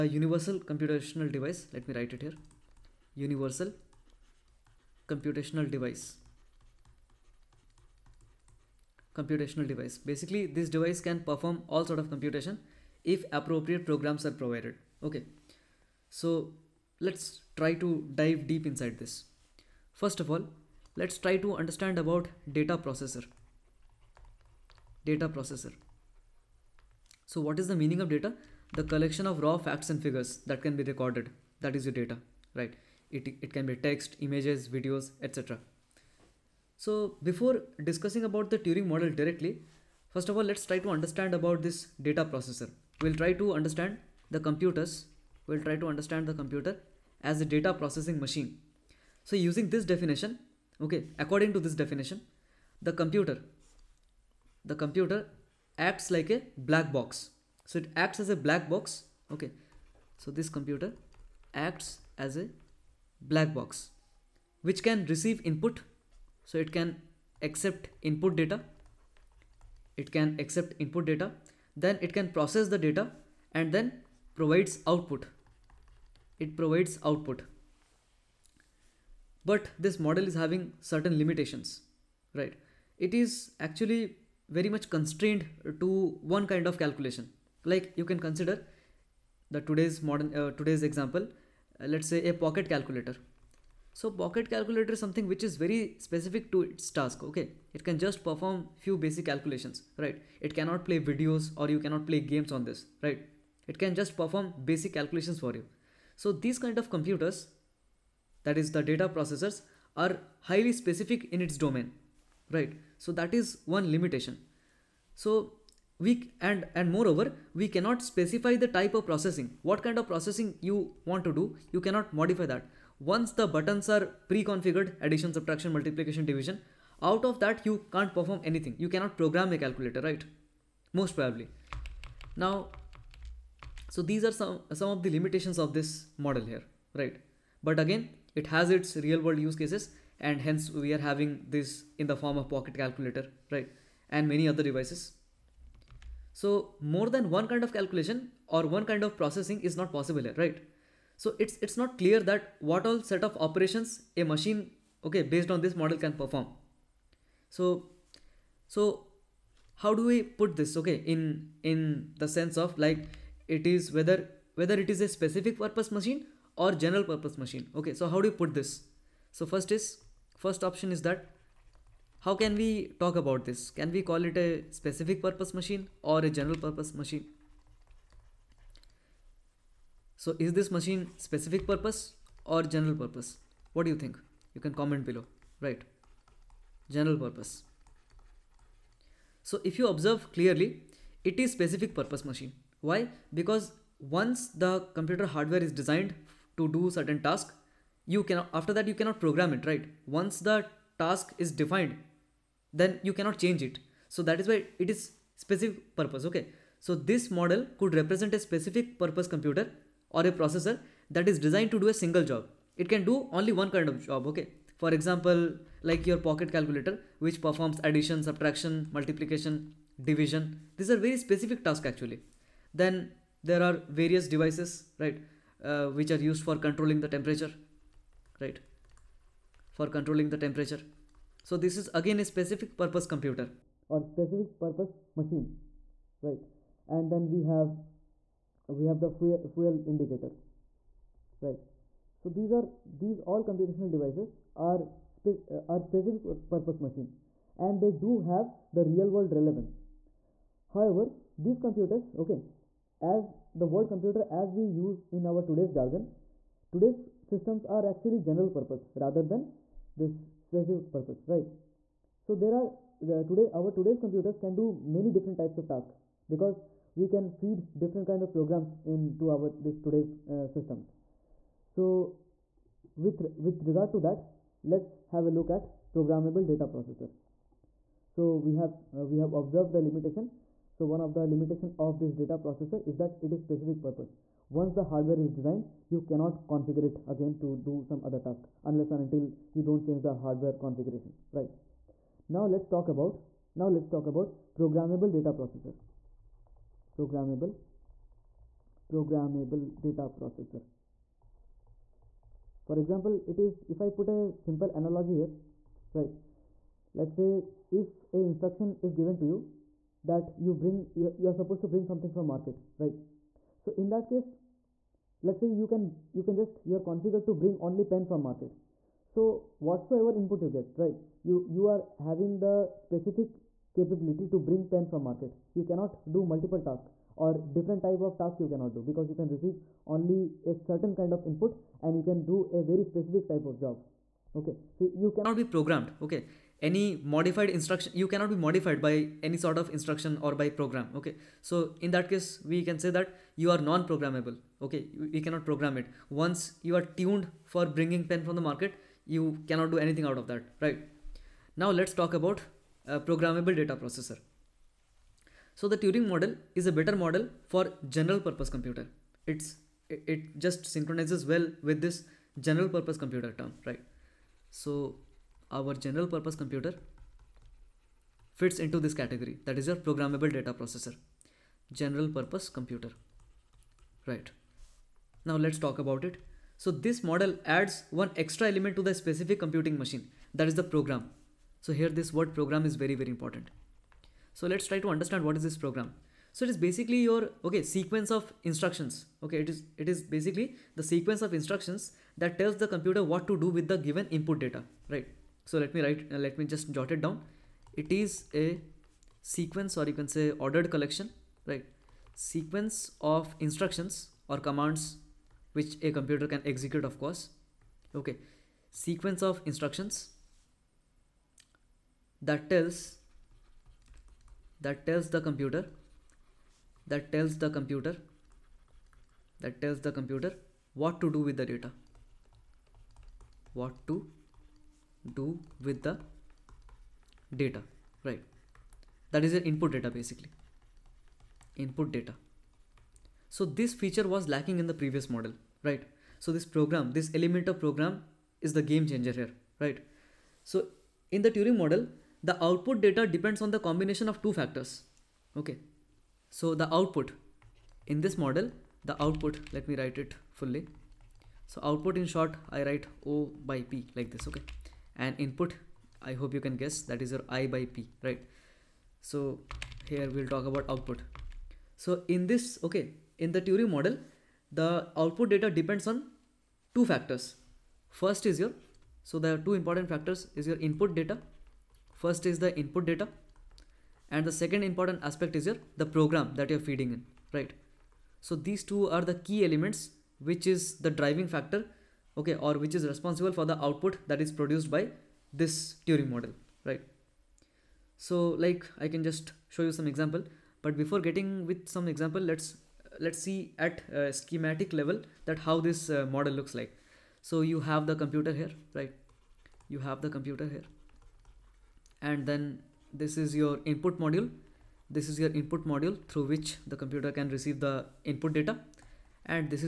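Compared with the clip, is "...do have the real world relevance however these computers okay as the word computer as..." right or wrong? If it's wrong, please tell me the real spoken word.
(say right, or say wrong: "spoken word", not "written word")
right.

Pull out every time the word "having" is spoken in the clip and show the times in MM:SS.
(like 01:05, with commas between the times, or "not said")
01:20, 02:20, 05:21.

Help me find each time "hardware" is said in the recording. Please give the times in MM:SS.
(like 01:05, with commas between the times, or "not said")
03:15, 04:44, 04:50.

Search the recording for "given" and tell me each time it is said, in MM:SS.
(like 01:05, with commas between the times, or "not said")
05:08, 06:33.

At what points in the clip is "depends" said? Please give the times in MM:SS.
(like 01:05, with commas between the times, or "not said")
07:23, 07:45.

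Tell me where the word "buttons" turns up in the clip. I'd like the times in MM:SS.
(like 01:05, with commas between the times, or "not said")
02:03.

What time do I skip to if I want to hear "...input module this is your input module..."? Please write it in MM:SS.
08:23.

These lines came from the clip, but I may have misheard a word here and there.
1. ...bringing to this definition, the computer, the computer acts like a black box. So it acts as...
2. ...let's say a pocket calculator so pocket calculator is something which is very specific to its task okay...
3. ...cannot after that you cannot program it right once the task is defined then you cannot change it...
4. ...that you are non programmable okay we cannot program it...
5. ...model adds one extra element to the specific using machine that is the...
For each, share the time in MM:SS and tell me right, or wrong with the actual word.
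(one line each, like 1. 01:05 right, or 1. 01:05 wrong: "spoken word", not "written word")
1. 00:51 wrong: "according", not "bringing"
2. 01:31 right
3. 03:18 right
4. 05:42 right
5. 06:17 wrong: "computing", not "using".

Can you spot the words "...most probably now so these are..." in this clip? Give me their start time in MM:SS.
02:11.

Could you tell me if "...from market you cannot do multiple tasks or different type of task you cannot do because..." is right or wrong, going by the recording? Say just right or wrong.
right.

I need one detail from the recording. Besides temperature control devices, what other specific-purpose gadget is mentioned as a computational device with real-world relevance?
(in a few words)
Fuel indicator.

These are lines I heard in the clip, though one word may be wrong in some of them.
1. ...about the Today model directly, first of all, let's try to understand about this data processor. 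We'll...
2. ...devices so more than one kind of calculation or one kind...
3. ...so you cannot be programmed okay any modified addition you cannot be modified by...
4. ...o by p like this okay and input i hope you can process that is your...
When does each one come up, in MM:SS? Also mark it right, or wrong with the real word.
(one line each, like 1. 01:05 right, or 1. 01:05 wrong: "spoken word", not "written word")
1. 00:38 wrong: "Turing", not "Today"
2. 02:24 right
3. 05:34 wrong: "instruction", not "addition"
4. 07:33 wrong: "guess", not "process".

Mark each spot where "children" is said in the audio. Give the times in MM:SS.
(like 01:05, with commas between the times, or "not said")
not said.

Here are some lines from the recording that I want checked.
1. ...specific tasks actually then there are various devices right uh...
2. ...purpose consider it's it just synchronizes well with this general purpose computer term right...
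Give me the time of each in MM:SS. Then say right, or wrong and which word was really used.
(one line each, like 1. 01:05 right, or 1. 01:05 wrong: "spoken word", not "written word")
1. 03:41 right
2. 05:58 wrong: "computer", not "consider".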